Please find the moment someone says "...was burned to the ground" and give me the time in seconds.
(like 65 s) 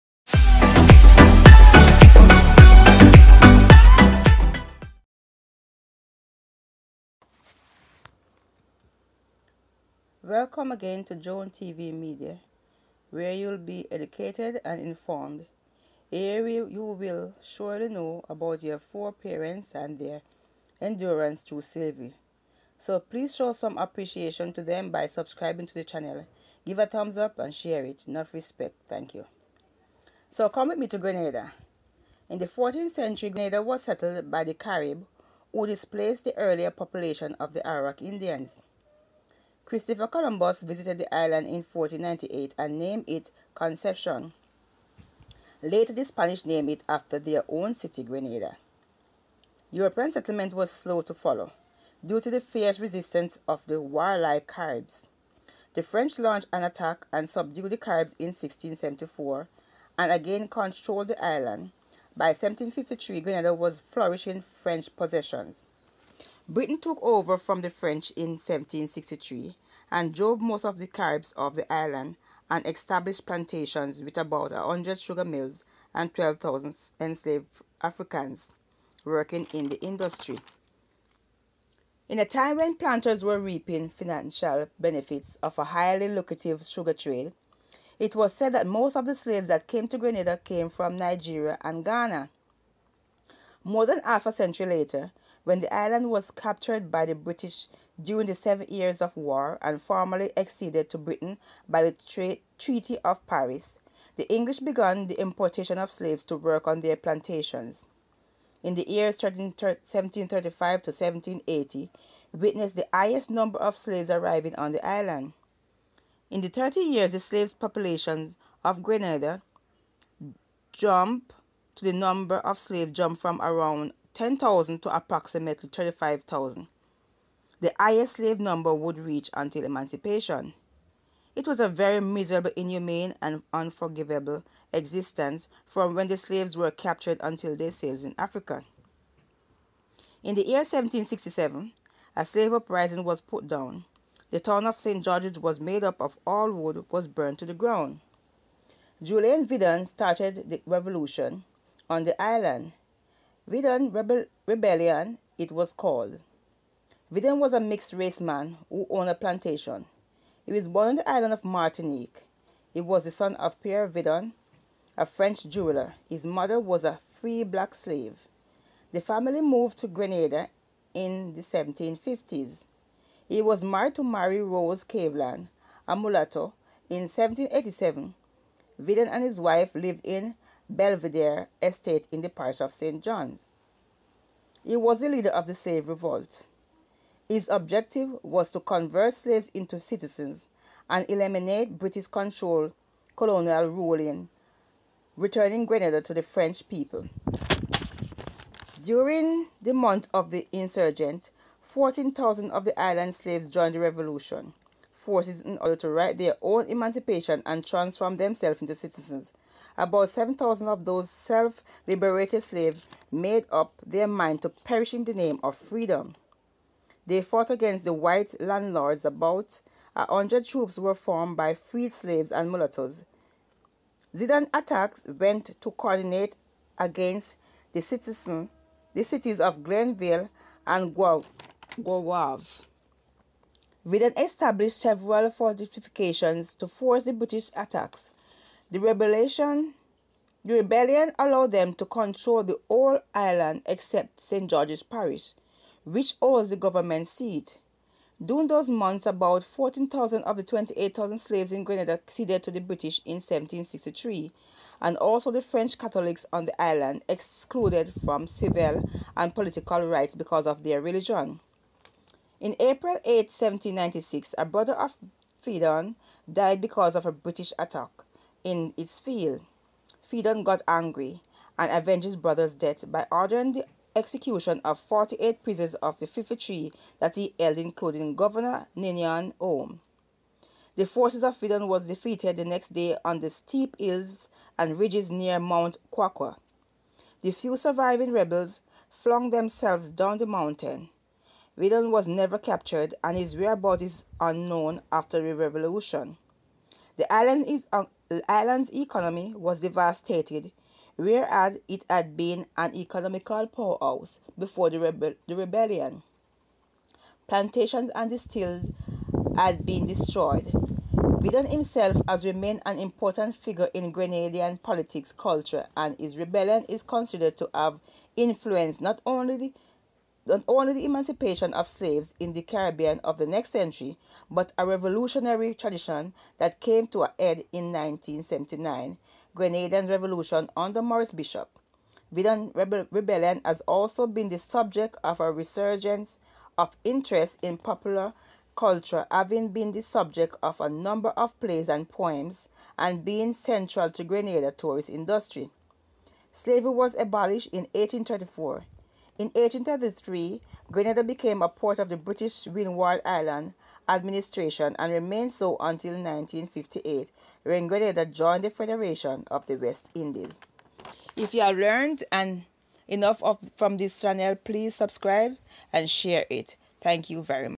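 146 s.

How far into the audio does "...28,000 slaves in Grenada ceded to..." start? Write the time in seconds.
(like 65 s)
250 s.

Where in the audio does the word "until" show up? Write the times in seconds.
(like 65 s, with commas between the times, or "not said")
129 s, 137 s, 355 s.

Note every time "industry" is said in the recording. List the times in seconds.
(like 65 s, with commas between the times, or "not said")
79 s, 344 s.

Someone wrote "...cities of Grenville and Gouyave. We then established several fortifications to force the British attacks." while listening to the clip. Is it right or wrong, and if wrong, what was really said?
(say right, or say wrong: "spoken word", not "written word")
right.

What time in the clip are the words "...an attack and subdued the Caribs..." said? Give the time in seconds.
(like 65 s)
56 s.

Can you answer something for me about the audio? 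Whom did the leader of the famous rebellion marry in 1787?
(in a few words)
Mary Rose Caveland.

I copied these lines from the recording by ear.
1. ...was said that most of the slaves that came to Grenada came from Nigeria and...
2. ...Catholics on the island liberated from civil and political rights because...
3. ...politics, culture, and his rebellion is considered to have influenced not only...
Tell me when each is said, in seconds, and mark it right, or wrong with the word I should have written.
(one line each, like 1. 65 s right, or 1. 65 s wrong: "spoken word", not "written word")
1. 88 s right
2. 255 s wrong: "excluded", not "liberated"
3. 314 s right.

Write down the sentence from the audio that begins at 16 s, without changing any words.
Here you will surely know about your four parents and their endurance through slavery.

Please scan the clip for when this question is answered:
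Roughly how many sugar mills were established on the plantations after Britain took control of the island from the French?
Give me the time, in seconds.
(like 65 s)
74 s.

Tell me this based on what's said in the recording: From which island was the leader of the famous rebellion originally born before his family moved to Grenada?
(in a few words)
Martinique.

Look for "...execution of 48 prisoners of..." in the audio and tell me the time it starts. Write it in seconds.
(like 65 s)
273 s.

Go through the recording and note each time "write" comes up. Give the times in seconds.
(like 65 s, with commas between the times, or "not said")
205 s.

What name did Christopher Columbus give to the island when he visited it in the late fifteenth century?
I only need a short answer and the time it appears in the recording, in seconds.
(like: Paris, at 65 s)
Concepcion, at 43 s.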